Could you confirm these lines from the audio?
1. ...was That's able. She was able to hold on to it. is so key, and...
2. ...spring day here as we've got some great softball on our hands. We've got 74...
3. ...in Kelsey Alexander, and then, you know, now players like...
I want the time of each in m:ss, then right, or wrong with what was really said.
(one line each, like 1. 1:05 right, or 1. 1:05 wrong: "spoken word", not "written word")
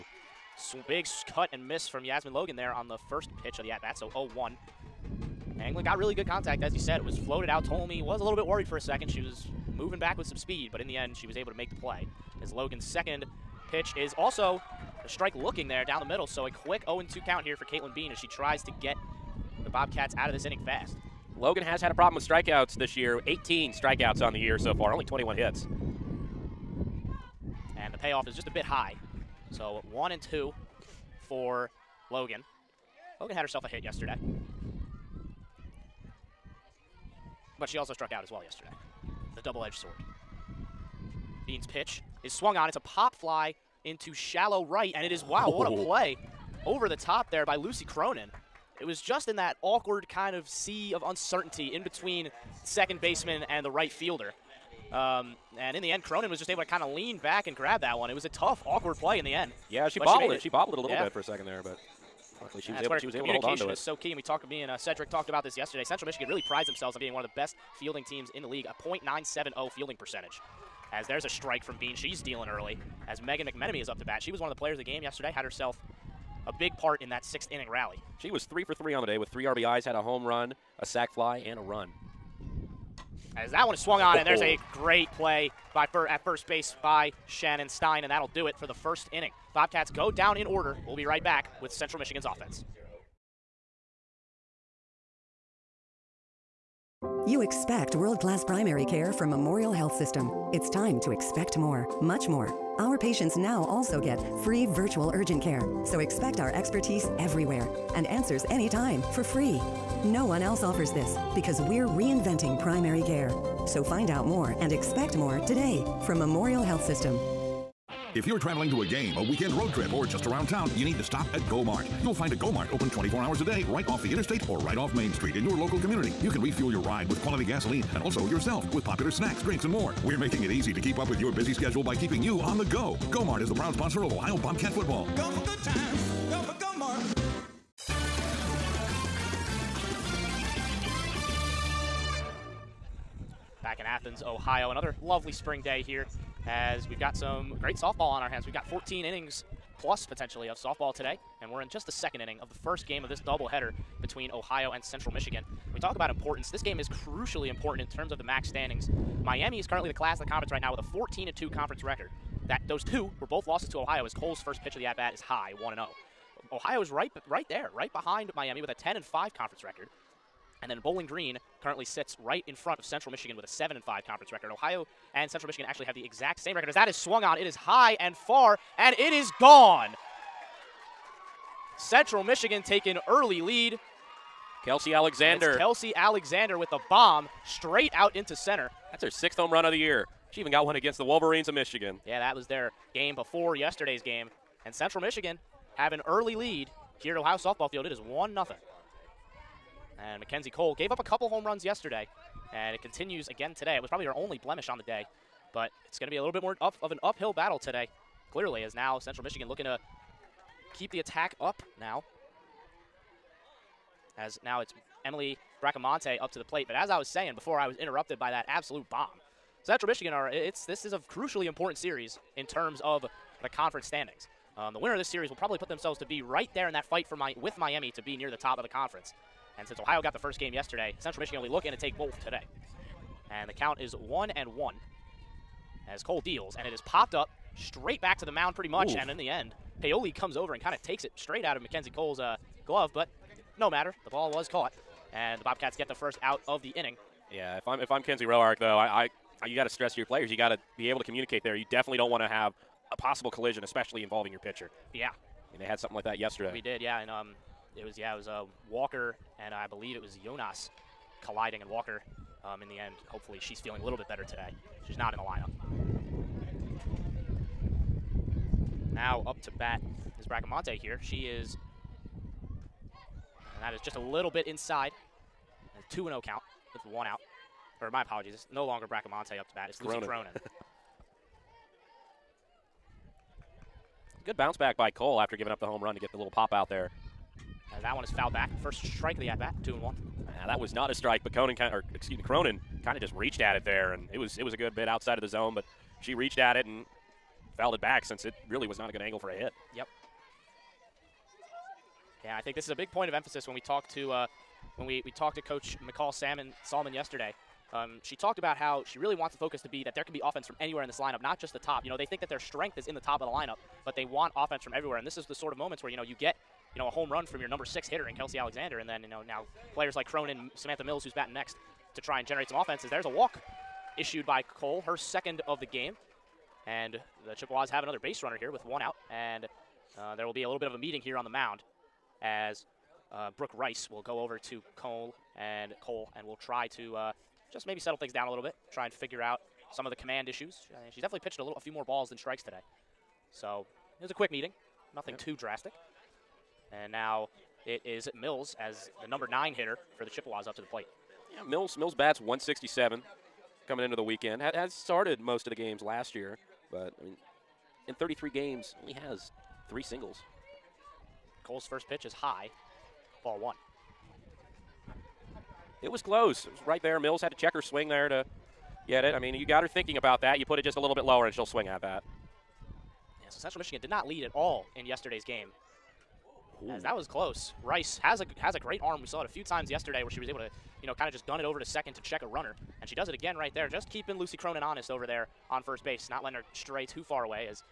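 1. 1:02 right
2. 2:25 wrong: "14", not "74"
3. 5:18 right.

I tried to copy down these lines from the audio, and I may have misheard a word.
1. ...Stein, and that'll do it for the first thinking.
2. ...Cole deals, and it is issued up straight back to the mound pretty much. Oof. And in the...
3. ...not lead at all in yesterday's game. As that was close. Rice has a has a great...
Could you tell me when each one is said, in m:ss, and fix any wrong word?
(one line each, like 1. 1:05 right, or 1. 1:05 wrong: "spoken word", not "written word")
1. 1:27 wrong: "inning", not "thinking"
2. 3:56 wrong: "popped", not "issued"
3. 6:13 right.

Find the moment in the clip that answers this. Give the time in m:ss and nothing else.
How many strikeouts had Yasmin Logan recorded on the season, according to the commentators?
0:23.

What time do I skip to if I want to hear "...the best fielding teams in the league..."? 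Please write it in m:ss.
1:07.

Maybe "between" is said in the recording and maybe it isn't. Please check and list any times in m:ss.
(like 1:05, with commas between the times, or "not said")
0:51, 2:34.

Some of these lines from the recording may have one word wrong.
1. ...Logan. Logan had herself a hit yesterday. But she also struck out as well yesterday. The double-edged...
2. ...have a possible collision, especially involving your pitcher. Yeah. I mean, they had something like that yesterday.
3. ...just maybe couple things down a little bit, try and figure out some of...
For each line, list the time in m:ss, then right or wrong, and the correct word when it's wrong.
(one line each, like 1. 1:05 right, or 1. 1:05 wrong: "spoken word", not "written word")
1. 0:32 right
2. 4:12 right
3. 5:37 wrong: "settle", not "couple".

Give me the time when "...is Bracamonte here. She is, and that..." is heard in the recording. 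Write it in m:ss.
4:30.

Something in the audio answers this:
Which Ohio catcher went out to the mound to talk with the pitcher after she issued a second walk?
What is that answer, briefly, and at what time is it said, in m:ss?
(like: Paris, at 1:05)
Brooke Rice, at 5:33.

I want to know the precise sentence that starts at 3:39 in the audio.
Central Michigan are it's this is a crucially important series in terms of the conference standings.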